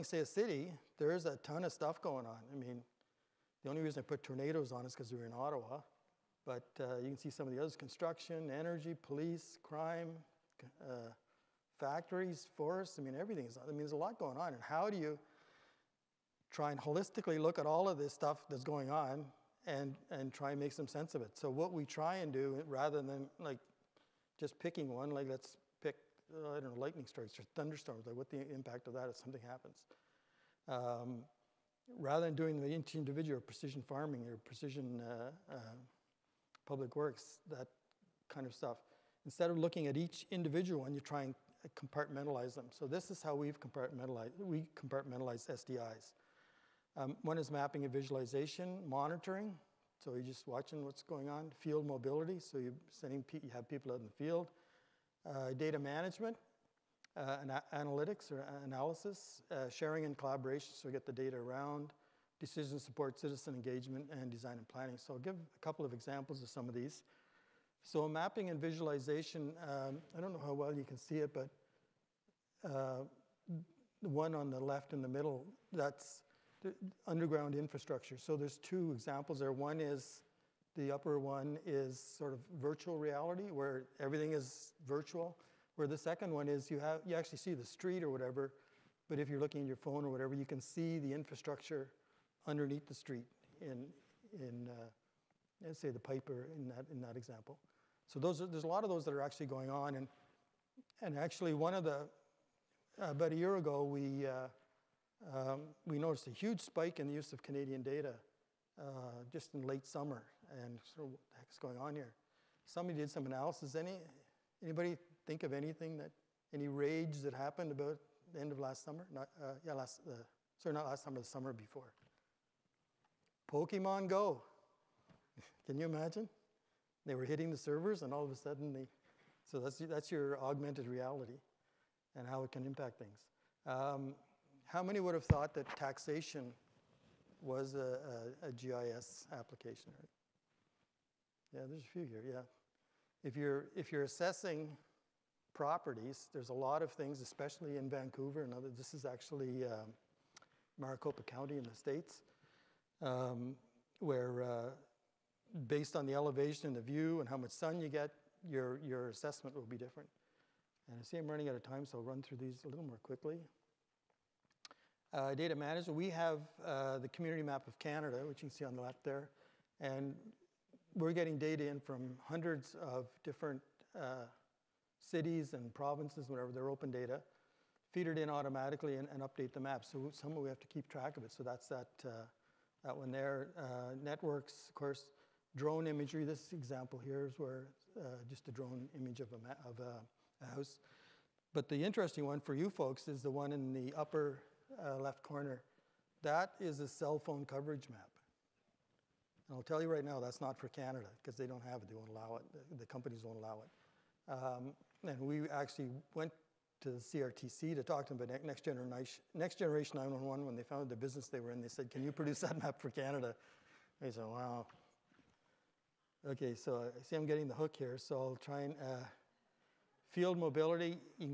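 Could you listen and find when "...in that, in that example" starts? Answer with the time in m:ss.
1:36.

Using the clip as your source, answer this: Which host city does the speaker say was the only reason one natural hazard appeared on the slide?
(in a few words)
Ottawa.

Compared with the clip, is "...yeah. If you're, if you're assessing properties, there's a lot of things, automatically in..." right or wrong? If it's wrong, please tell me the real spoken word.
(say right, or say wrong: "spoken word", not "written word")
wrong: "especially", not "automatically".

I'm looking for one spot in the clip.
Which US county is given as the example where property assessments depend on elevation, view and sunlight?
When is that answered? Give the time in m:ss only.
2:30.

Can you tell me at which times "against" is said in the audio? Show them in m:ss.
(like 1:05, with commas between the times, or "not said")
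not said.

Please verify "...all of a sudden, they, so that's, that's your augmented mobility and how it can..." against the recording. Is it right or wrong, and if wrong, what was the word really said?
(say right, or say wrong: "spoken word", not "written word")
wrong: "reality", not "mobility".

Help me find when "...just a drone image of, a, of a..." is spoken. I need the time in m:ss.
3:08.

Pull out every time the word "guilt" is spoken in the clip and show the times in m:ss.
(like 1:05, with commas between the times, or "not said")
not said.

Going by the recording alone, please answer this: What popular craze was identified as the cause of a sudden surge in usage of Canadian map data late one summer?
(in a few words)
Pokemon Go.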